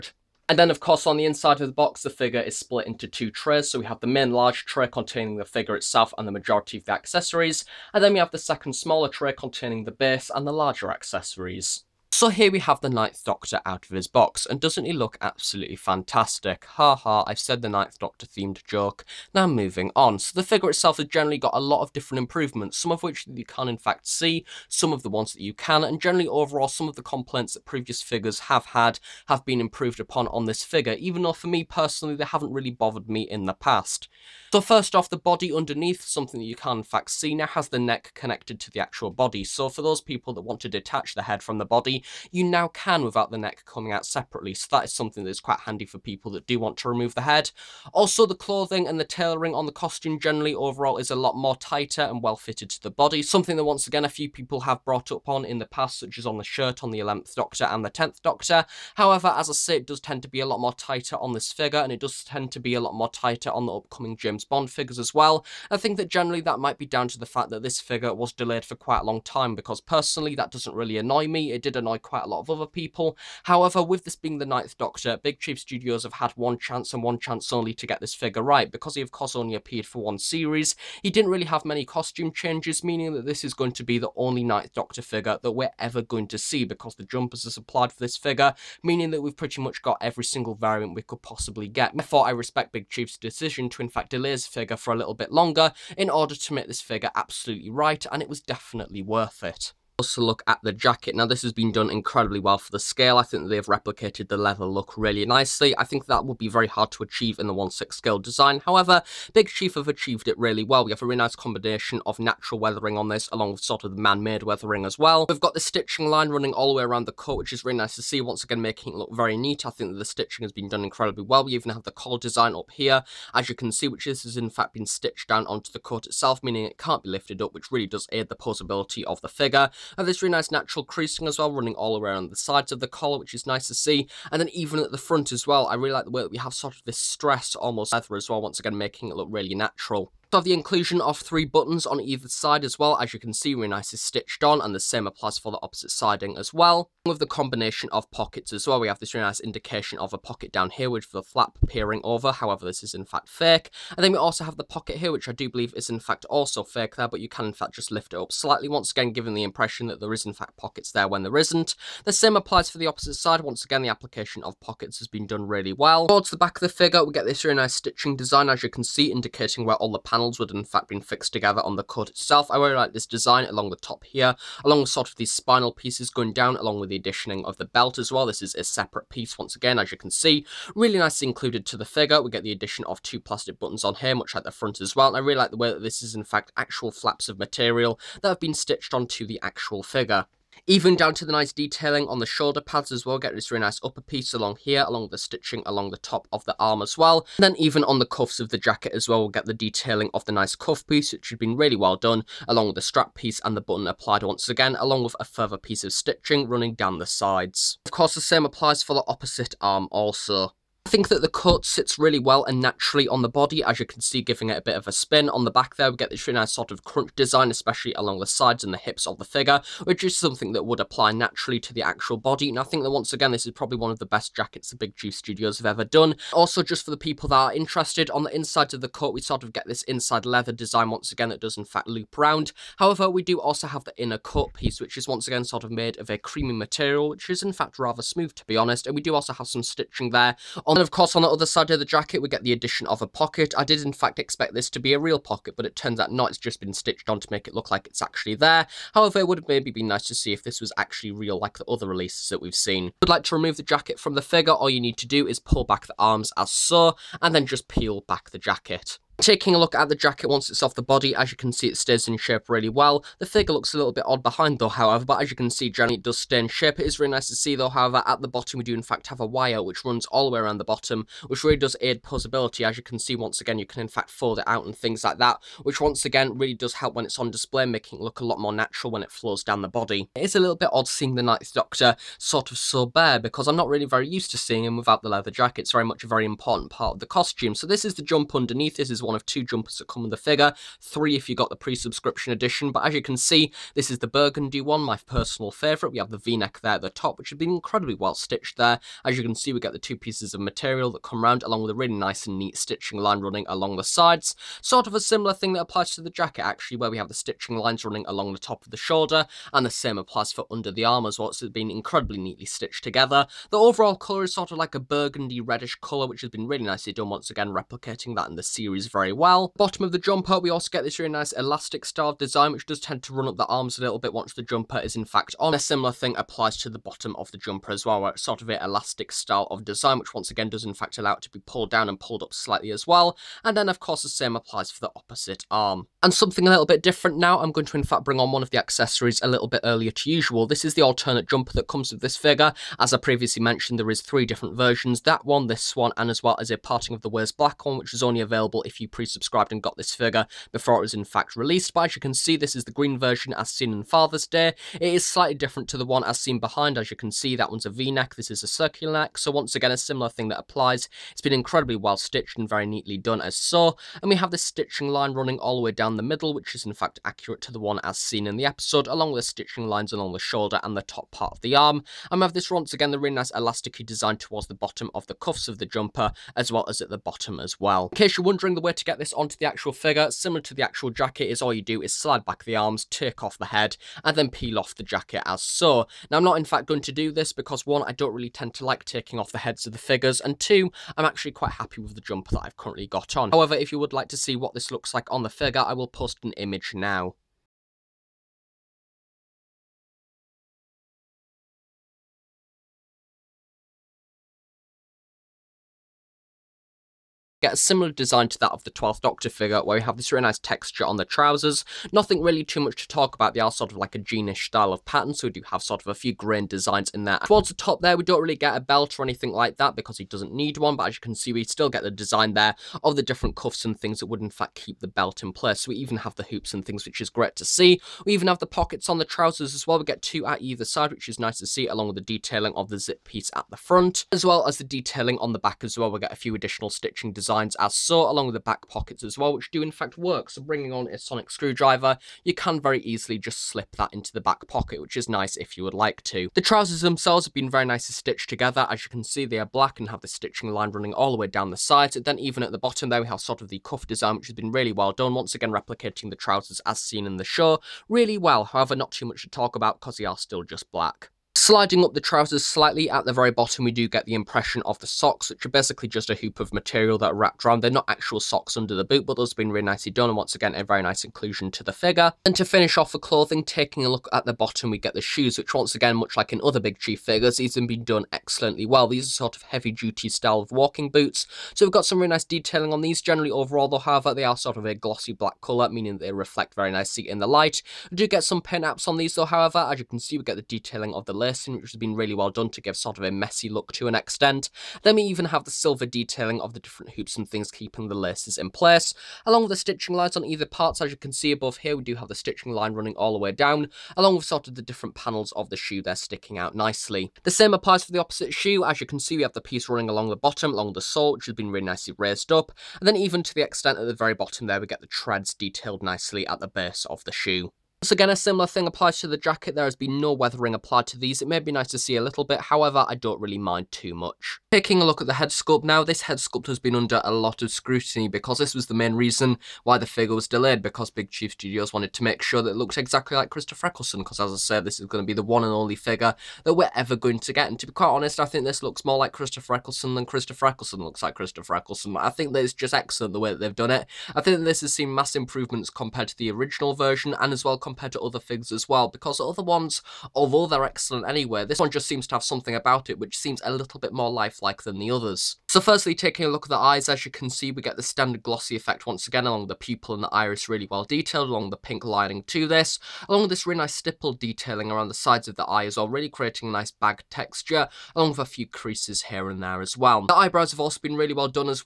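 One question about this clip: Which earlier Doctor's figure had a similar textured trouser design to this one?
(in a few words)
The 12th Doctor.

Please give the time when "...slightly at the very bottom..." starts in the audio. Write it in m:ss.
7:42.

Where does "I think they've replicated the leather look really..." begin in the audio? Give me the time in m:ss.
1:43.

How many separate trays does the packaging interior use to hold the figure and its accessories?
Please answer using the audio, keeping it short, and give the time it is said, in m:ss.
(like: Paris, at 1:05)
2, at 0:03.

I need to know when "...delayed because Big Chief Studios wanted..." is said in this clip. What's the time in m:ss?
8:50.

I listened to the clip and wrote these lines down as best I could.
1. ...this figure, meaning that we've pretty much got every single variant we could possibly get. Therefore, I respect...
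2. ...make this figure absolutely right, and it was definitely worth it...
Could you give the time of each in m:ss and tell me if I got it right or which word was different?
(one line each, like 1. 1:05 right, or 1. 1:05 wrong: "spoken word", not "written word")
1. 1:27 right
2. 1:36 right.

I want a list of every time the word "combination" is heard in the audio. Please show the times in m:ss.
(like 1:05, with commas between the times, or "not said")
1:51, 2:27.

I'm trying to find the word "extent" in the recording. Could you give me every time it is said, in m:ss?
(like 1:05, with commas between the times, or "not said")
8:13, 8:33.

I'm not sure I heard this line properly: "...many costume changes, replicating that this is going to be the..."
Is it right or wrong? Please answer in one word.
wrong.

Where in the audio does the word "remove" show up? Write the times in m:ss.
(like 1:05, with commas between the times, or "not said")
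0:46, 4:13.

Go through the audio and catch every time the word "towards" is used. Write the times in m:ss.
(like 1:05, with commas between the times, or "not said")
2:46, 6:14, 6:57.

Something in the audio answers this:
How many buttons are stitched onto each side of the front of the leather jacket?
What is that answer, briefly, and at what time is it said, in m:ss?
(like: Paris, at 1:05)
3, at 2:21.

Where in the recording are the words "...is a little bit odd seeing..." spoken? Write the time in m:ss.
4:40.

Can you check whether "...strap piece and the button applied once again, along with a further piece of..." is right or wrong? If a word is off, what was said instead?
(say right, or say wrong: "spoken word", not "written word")
right.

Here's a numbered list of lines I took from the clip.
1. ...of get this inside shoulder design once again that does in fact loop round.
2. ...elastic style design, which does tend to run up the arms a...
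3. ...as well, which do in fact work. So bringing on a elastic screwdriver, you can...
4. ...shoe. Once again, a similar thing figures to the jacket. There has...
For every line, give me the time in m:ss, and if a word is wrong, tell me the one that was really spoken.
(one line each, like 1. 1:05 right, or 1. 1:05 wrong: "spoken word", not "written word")
1. 3:49 wrong: "leather", not "shoulder"
2. 5:21 right
3. 7:19 wrong: "sonic", not "elastic"
4. 8:37 wrong: "applies", not "figures".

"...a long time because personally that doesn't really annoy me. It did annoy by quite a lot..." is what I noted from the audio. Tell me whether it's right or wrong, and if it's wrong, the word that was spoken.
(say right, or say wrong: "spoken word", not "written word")
right.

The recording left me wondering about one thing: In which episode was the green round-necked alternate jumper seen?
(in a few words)
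Father's Day.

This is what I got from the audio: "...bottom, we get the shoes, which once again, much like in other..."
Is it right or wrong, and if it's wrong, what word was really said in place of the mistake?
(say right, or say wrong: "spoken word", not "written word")
right.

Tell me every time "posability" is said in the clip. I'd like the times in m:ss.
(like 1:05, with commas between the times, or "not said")
2:08, 4:32.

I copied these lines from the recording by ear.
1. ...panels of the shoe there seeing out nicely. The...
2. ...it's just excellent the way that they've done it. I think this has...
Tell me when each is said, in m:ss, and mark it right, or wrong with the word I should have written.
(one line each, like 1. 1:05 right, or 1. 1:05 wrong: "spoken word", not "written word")
1. 8:24 wrong: "sticking", not "seeing"
2. 9:02 right.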